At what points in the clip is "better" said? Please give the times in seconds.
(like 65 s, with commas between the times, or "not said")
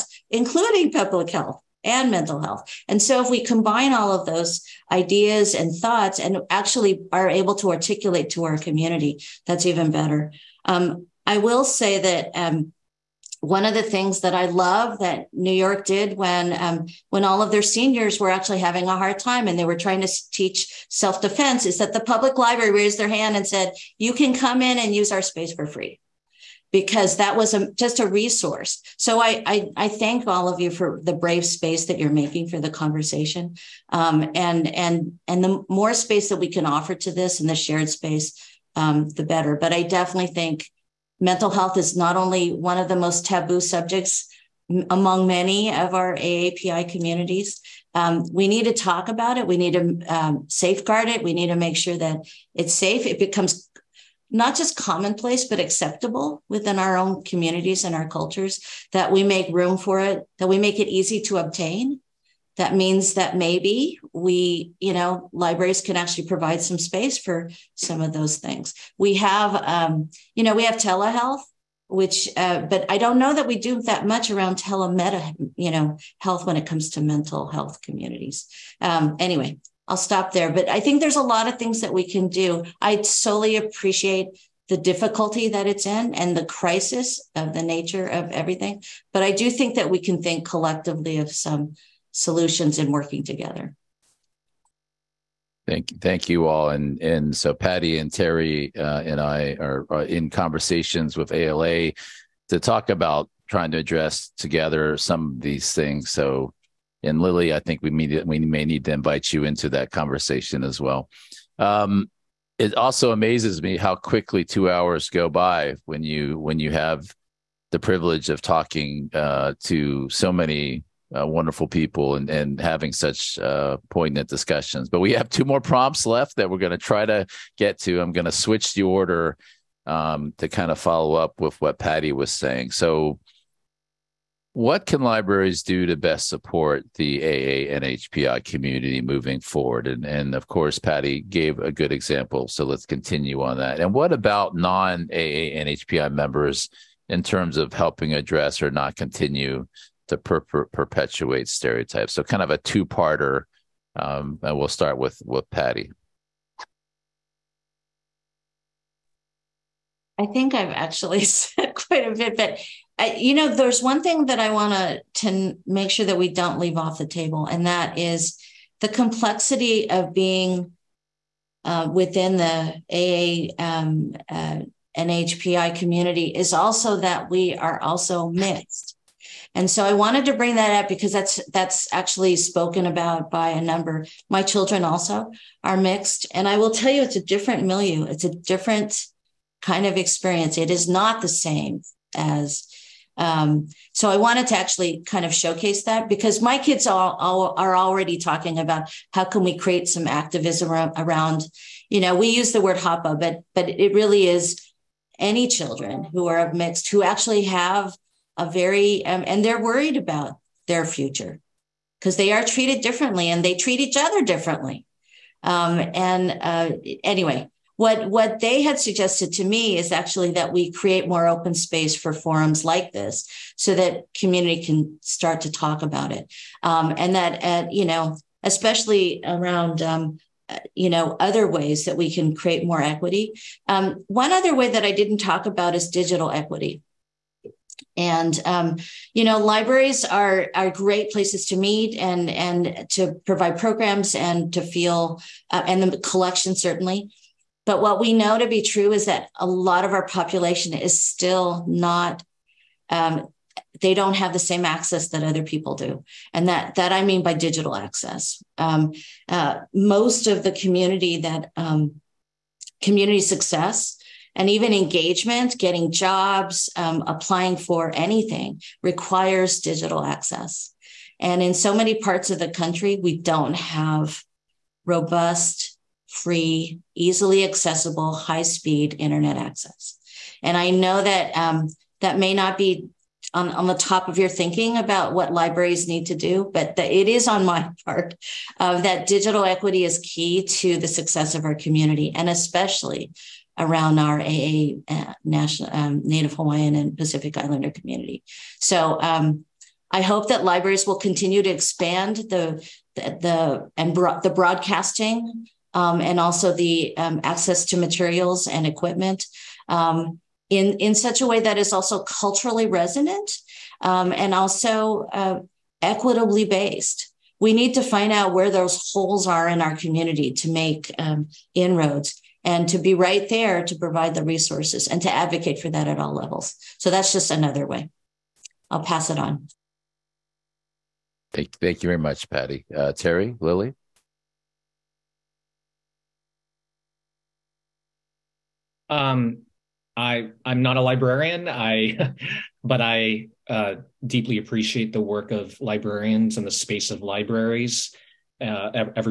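9 s, 39 s.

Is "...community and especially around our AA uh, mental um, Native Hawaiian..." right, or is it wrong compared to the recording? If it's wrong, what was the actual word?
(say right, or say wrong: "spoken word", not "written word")
wrong: "national", not "mental".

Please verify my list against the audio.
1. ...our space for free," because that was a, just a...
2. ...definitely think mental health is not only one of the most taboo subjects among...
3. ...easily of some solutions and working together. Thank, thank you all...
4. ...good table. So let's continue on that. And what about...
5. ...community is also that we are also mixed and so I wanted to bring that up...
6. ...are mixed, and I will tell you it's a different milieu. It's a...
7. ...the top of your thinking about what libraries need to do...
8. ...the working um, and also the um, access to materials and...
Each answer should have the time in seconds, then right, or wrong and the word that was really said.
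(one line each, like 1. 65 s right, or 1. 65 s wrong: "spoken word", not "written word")
1. 25 s right
2. 39 s right
3. 90 s wrong: "collectively", not "easily"
4. 141 s wrong: "example", not "table"
5. 175 s right
6. 185 s right
7. 283 s right
8. 304 s wrong: "broadcasting", not "working".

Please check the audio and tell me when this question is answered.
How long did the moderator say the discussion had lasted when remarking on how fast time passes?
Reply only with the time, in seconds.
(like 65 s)
114 s.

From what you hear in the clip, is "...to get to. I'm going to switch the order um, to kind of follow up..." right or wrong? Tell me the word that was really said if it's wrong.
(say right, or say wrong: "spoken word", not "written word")
right.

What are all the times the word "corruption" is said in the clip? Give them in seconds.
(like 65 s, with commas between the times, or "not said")
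not said.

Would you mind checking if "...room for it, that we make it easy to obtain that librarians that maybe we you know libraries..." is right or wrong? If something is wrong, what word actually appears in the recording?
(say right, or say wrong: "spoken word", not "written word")
wrong: "means", not "librarians".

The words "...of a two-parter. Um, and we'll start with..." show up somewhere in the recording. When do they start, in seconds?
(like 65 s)
152 s.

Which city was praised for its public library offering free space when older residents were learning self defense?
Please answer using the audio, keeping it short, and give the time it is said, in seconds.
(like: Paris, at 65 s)
New York, at 15 s.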